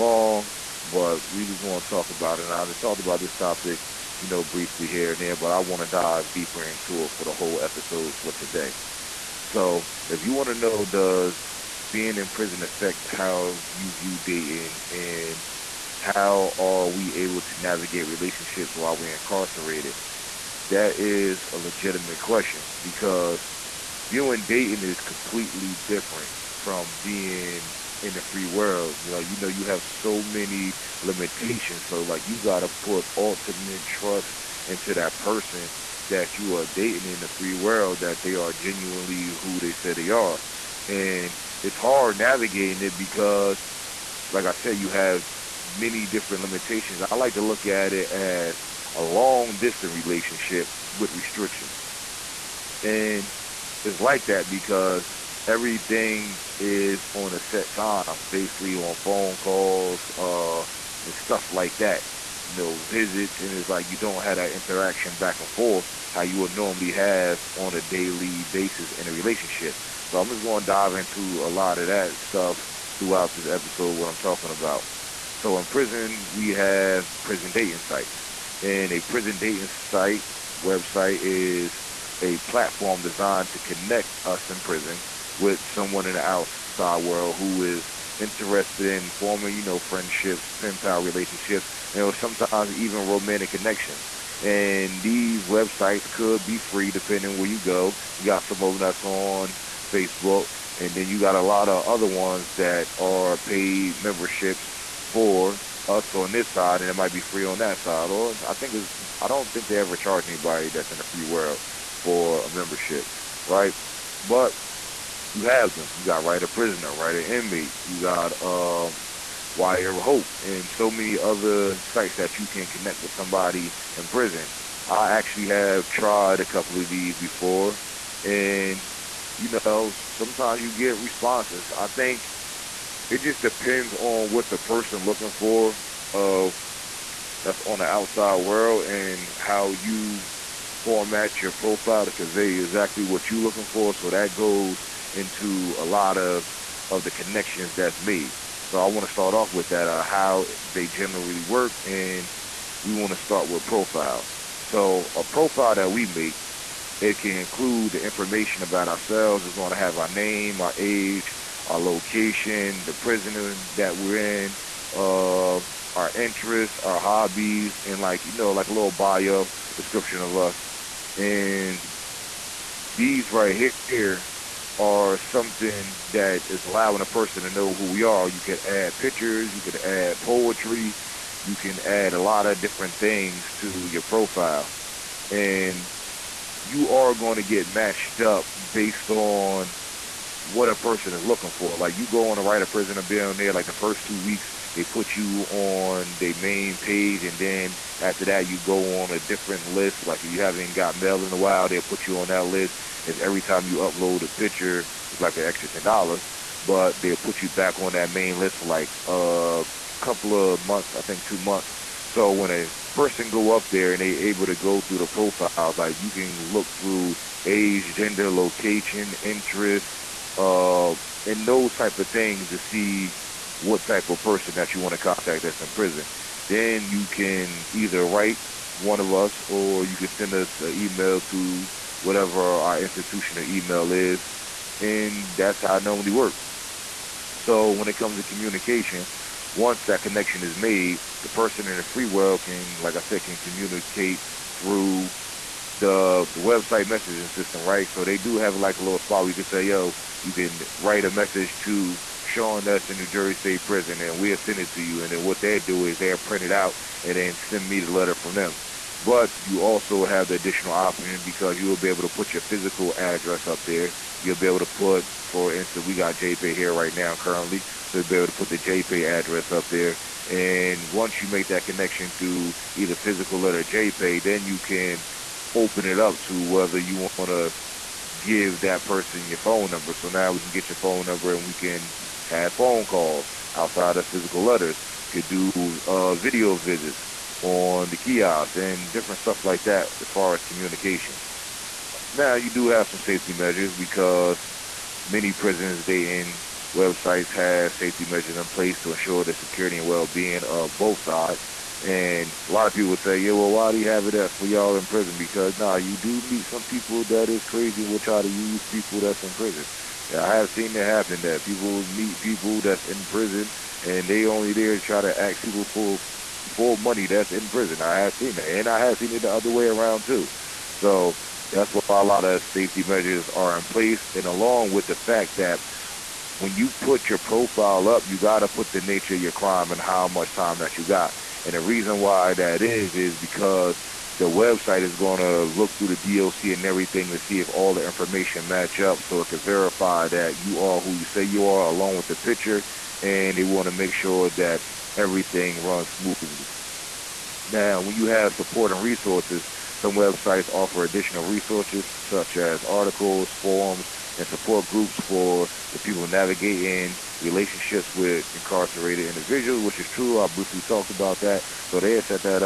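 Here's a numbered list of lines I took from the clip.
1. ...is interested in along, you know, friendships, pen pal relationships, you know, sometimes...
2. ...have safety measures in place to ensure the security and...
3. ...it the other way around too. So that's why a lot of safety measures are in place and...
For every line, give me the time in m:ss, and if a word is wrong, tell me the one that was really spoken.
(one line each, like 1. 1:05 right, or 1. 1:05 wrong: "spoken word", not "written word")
1. 1:27 wrong: "forming", not "along"
2. 4:57 right
3. 5:19 right.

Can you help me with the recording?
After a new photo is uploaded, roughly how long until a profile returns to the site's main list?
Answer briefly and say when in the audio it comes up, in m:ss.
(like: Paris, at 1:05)
2 months, at 3:31.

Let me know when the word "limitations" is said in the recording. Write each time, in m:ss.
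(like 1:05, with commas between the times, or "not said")
0:31, 0:46.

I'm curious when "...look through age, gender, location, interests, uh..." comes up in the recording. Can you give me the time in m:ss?
3:36.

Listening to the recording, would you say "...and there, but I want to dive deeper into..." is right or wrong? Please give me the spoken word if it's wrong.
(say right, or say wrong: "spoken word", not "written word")
right.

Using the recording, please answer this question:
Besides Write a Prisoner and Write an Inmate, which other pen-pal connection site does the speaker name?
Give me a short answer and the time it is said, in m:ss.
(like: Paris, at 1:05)
Wire Hope, at 1:59.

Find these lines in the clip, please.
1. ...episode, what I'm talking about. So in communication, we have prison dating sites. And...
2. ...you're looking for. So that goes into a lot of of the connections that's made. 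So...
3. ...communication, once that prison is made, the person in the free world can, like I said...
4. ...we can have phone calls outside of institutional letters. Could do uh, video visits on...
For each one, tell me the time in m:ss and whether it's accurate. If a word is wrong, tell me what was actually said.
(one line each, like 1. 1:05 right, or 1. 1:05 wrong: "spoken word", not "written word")
1. 1:13 wrong: "prison", not "communication"
2. 2:23 right
3. 3:58 wrong: "connection", not "prison"
4. 4:41 wrong: "physical", not "institutional".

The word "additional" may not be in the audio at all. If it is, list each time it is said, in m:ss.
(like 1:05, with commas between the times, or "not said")
4:20, 5:50.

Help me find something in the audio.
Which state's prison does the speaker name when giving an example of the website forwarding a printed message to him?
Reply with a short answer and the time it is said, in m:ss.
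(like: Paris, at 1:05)
New Jersey, at 4:12.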